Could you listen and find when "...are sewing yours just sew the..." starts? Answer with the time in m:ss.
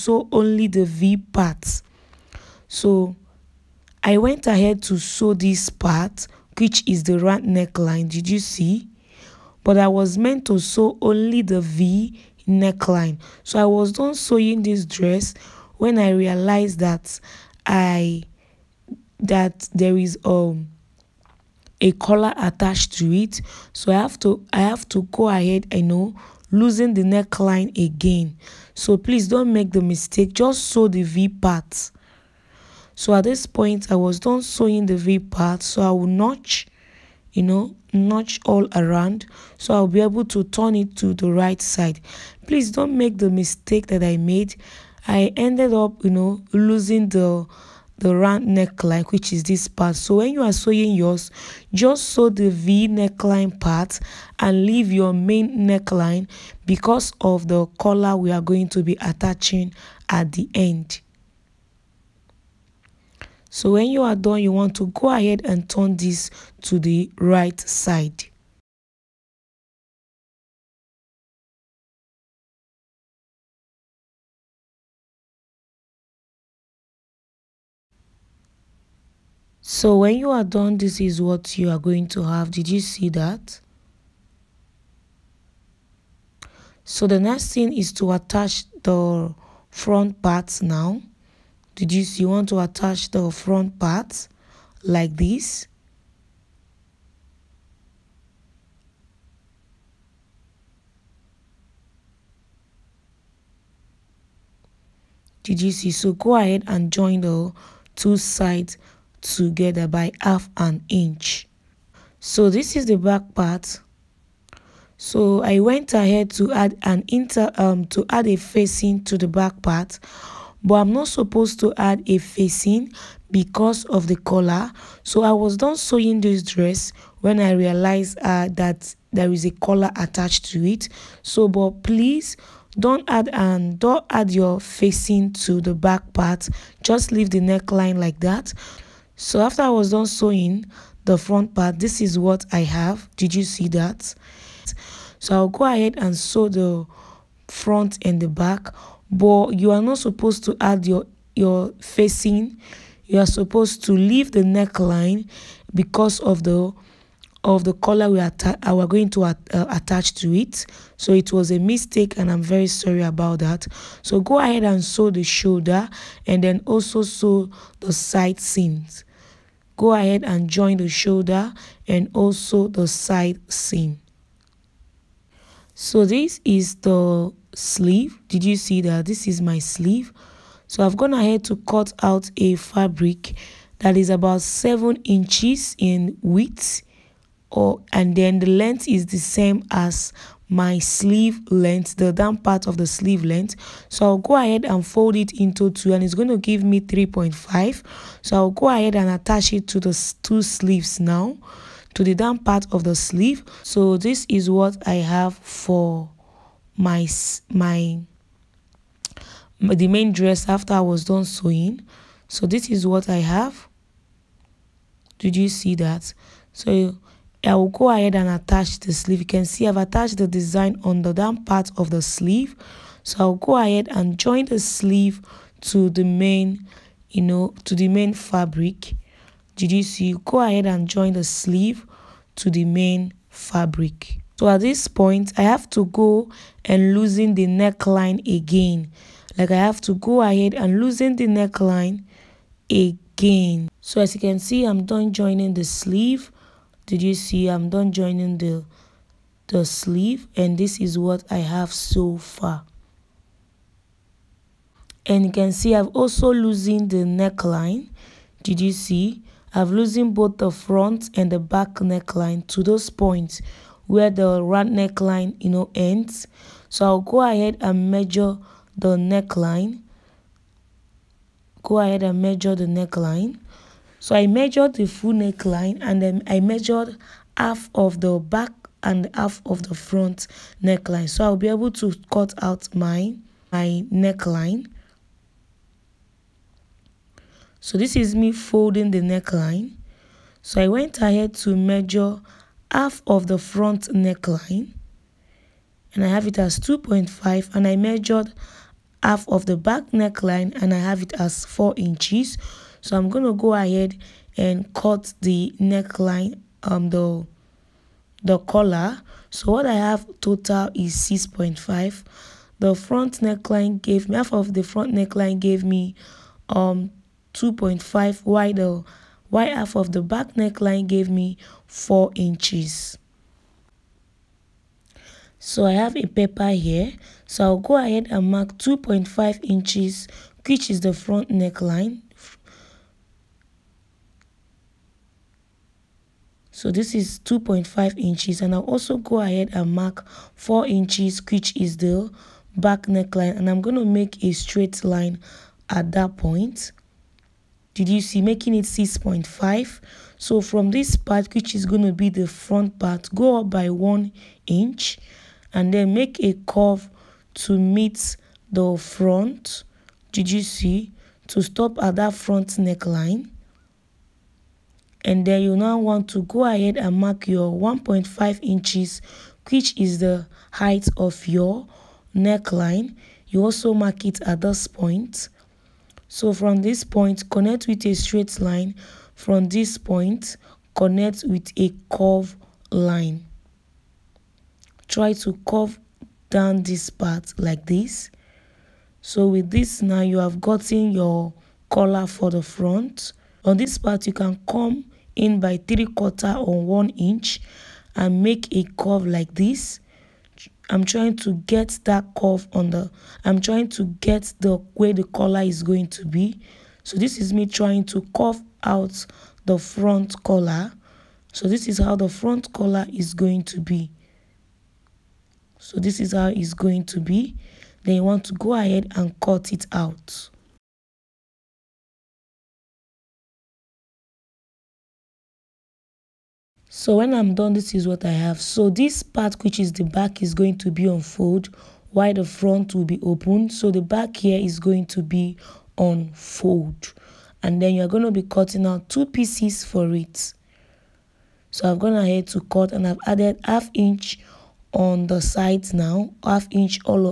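0:50.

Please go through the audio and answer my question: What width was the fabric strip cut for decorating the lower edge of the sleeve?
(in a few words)
7 inches.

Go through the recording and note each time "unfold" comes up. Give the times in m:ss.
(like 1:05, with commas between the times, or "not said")
7:10, 7:15.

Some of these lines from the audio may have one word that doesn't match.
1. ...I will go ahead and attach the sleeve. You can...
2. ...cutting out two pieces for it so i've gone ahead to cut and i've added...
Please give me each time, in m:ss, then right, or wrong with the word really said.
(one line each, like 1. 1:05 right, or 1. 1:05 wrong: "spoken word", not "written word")
1. 3:37 right
2. 7:18 right.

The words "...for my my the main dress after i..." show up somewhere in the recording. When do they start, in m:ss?
3:25.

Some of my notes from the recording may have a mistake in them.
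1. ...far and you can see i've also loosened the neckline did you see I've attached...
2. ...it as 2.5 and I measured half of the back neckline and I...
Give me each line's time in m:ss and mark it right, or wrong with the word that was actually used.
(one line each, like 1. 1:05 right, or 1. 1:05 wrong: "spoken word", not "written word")
1. 4:12 wrong: "loosened", not "attached"
2. 4:56 right.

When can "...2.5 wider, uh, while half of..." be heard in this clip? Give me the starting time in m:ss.
5:17.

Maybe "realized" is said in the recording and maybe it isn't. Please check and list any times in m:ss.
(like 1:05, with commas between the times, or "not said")
0:16, 2:07.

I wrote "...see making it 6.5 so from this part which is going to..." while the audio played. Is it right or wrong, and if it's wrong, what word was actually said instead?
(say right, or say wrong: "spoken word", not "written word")
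right.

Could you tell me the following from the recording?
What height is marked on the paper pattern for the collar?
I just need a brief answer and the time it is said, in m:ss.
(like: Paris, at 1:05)
1.5 inches, at 6:07.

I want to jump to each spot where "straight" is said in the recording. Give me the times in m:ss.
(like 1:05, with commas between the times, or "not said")
5:44, 6:17.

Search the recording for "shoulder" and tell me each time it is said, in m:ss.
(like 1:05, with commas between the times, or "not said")
2:45, 2:50.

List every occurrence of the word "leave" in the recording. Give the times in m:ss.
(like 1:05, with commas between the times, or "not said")
0:54, 2:17, 2:33.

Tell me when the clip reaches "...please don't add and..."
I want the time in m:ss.
2:11.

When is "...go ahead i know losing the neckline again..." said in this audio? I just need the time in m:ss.
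0:25.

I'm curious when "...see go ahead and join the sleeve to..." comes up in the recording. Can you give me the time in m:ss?
3:49.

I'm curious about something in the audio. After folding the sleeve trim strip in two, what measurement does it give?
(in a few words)
3.5.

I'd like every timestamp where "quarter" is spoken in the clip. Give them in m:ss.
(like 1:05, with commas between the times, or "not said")
6:35.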